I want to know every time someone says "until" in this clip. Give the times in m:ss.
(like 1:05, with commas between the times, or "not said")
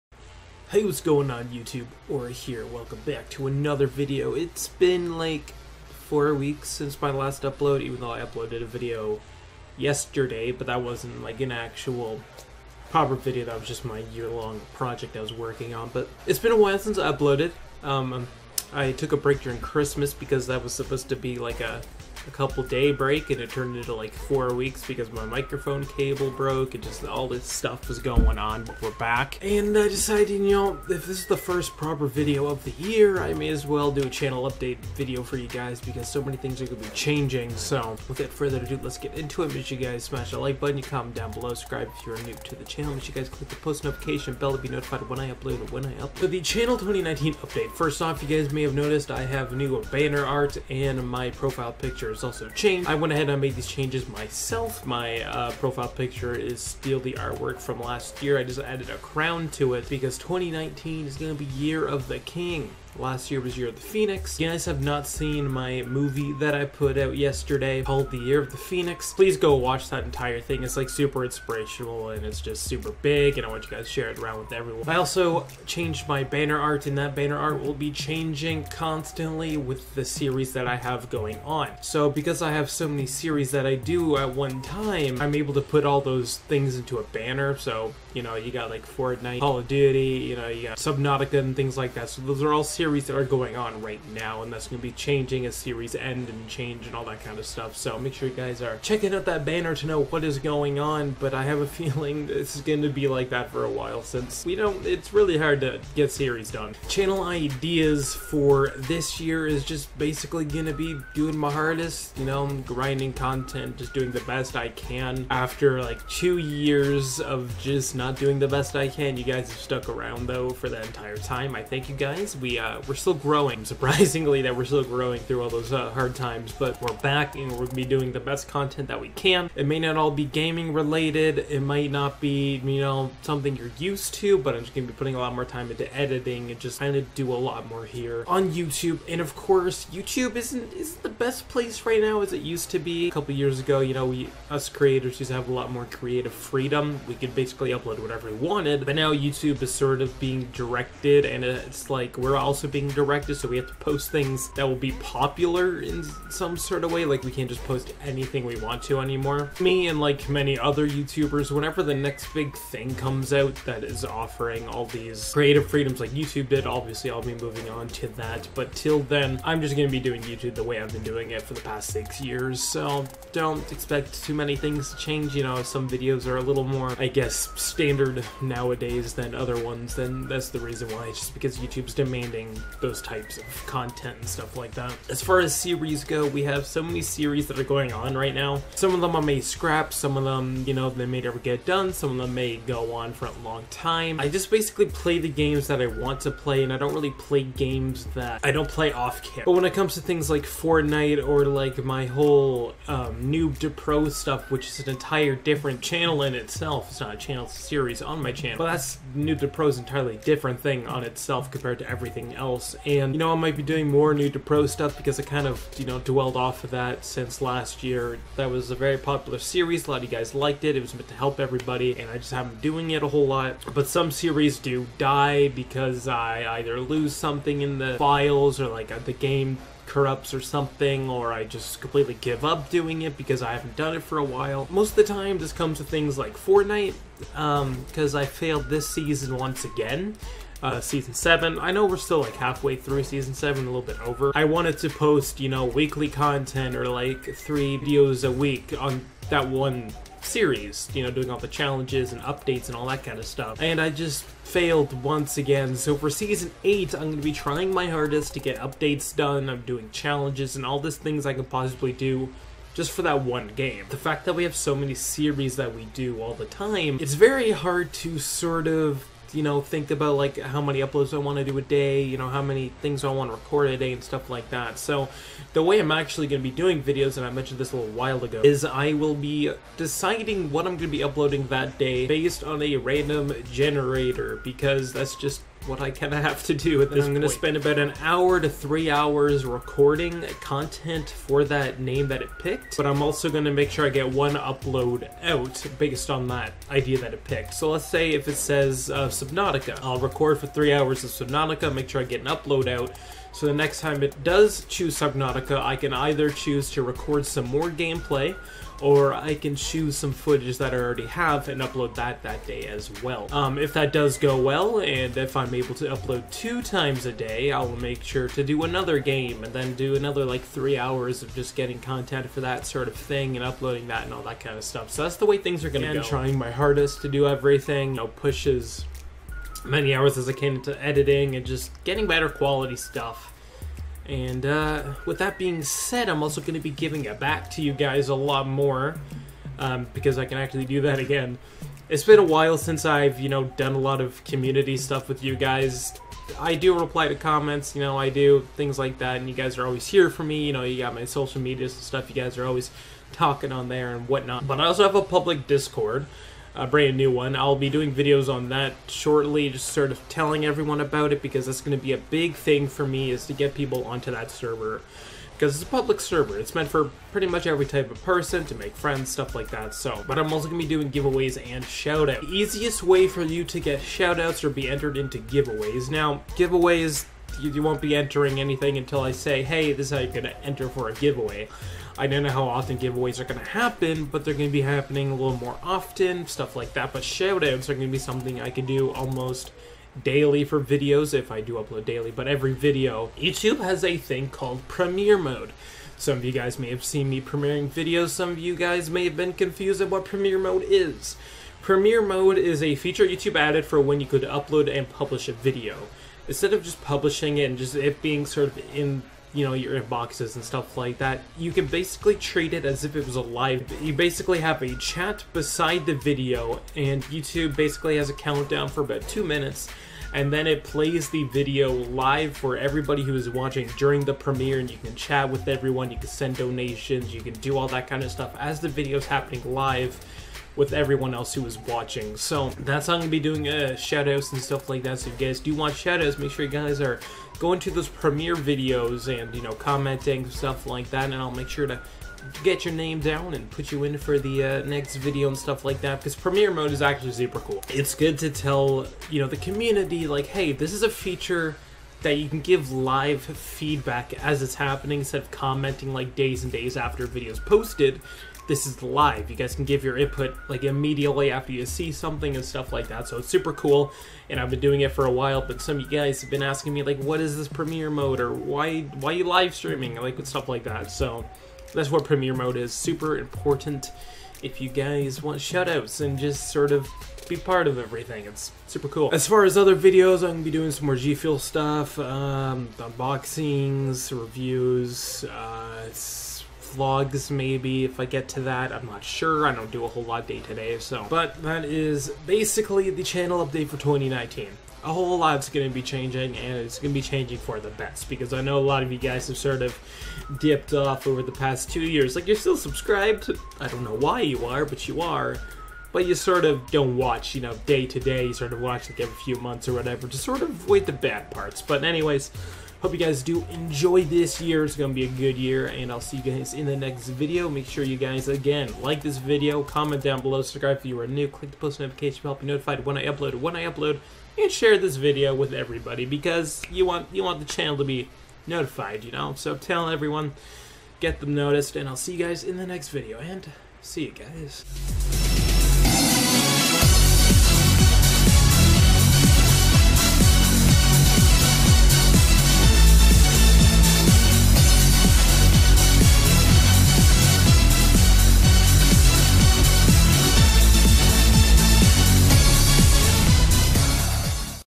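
6:18.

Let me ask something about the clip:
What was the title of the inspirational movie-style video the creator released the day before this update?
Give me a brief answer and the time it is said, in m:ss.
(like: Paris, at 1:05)
The Year of the Phoenix, at 1:08.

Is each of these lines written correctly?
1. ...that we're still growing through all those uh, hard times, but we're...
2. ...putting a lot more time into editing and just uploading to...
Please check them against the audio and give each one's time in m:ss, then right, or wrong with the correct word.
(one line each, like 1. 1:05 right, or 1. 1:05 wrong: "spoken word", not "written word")
1. 2:04 right
2. 2:14 wrong: "trying", not "uploading".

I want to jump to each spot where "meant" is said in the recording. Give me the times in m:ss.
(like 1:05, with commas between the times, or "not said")
3:40, 6:06.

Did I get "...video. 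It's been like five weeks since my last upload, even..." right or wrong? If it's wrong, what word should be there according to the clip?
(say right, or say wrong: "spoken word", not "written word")
wrong: "four", not "five".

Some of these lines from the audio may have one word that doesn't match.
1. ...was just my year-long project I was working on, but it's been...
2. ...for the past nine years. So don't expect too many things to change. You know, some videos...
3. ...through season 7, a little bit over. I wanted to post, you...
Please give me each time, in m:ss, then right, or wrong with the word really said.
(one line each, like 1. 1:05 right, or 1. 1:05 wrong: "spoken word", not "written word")
1. 0:13 right
2. 2:51 wrong: "six", not "nine"
3. 4:02 right.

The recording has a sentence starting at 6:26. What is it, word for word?
But shoutouts are going to be something I can do almost daily for videos if I do upload daily, but every video.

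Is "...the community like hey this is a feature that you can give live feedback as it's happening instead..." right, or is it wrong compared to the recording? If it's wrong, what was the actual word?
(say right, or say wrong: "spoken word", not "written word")
right.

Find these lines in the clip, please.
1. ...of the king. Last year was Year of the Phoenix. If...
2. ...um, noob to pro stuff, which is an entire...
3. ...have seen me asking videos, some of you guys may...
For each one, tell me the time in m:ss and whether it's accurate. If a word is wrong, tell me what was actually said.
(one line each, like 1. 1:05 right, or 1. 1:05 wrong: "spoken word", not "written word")
1. 1:01 right
2. 3:22 right
3. 6:36 wrong: "premiering", not "asking".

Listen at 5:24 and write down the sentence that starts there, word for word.
So that's the way things are going to go.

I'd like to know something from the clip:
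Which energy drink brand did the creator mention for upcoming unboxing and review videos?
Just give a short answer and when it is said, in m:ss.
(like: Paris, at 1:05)
G Fuel, at 8:00.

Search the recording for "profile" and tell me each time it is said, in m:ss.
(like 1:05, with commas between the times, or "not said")
0:51, 0:55.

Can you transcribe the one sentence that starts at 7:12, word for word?
So that's how I'm gonna be doing uh, shoutouts and stuff like that.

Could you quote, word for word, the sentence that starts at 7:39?
You guys can give your input like immediately after you see something and stuff like that.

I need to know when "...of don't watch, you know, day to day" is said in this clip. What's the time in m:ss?
8:26.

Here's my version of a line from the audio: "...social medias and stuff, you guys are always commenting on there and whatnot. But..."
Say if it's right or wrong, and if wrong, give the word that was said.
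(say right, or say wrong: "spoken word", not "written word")
wrong: "talking", not "commenting".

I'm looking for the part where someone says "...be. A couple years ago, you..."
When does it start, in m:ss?
2:22.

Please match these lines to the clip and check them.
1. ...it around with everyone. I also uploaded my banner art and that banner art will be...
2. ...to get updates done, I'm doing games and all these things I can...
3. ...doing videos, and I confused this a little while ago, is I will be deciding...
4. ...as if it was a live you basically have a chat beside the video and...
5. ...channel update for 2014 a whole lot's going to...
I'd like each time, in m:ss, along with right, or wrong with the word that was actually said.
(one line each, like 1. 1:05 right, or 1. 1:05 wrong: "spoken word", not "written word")
1. 1:14 wrong: "changed", not "uploaded"
2. 4:18 wrong: "challenges", not "games"
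3. 4:36 wrong: "mentioned", not "confused"
4. 6:52 right
5. 8:13 wrong: "2019", not "2014".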